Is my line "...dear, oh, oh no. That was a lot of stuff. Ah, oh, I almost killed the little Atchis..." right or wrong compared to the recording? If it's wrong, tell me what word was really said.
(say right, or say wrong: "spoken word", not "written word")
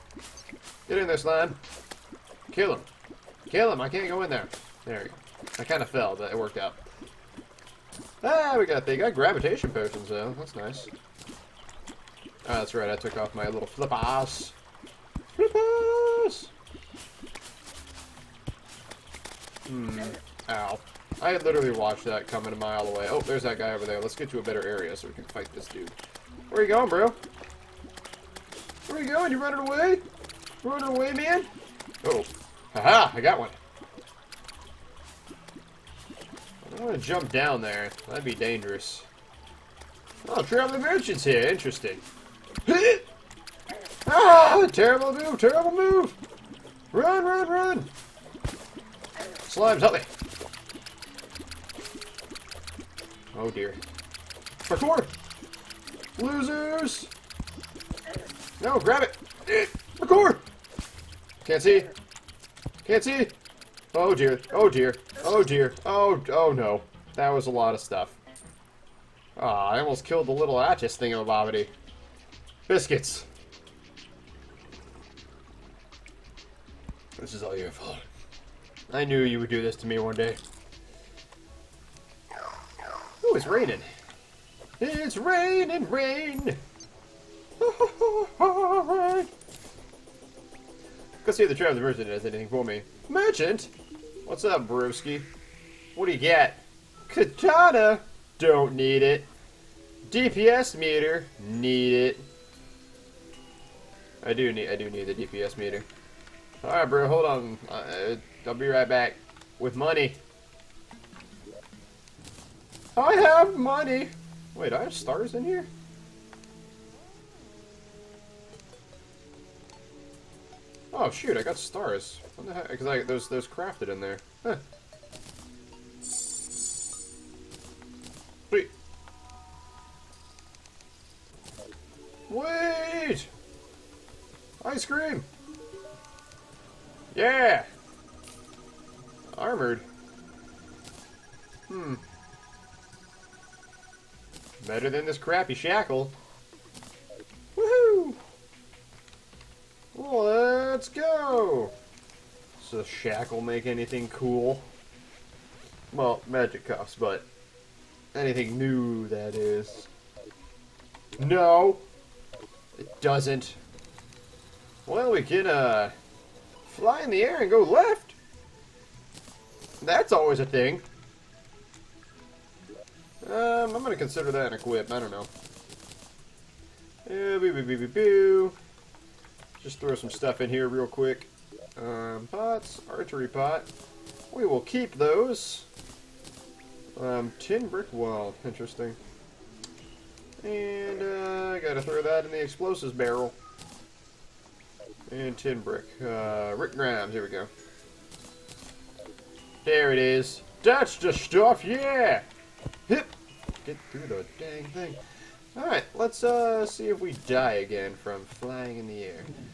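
right.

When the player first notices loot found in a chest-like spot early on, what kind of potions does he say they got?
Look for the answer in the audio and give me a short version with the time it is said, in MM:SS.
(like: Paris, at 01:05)
Gravitation potions, at 00:09.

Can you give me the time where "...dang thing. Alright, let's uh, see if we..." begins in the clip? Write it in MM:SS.
03:24.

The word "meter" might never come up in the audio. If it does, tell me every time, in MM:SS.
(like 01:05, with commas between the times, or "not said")
01:40, 01:45.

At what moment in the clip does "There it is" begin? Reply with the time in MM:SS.
03:19.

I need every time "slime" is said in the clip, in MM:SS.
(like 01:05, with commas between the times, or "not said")
00:01, 00:49.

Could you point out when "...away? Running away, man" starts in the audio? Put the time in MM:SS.
00:29.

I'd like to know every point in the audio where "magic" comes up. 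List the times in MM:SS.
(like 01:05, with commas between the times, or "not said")
02:36.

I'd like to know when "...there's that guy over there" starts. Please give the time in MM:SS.
00:23.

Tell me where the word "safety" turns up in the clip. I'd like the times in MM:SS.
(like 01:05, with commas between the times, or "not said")
not said.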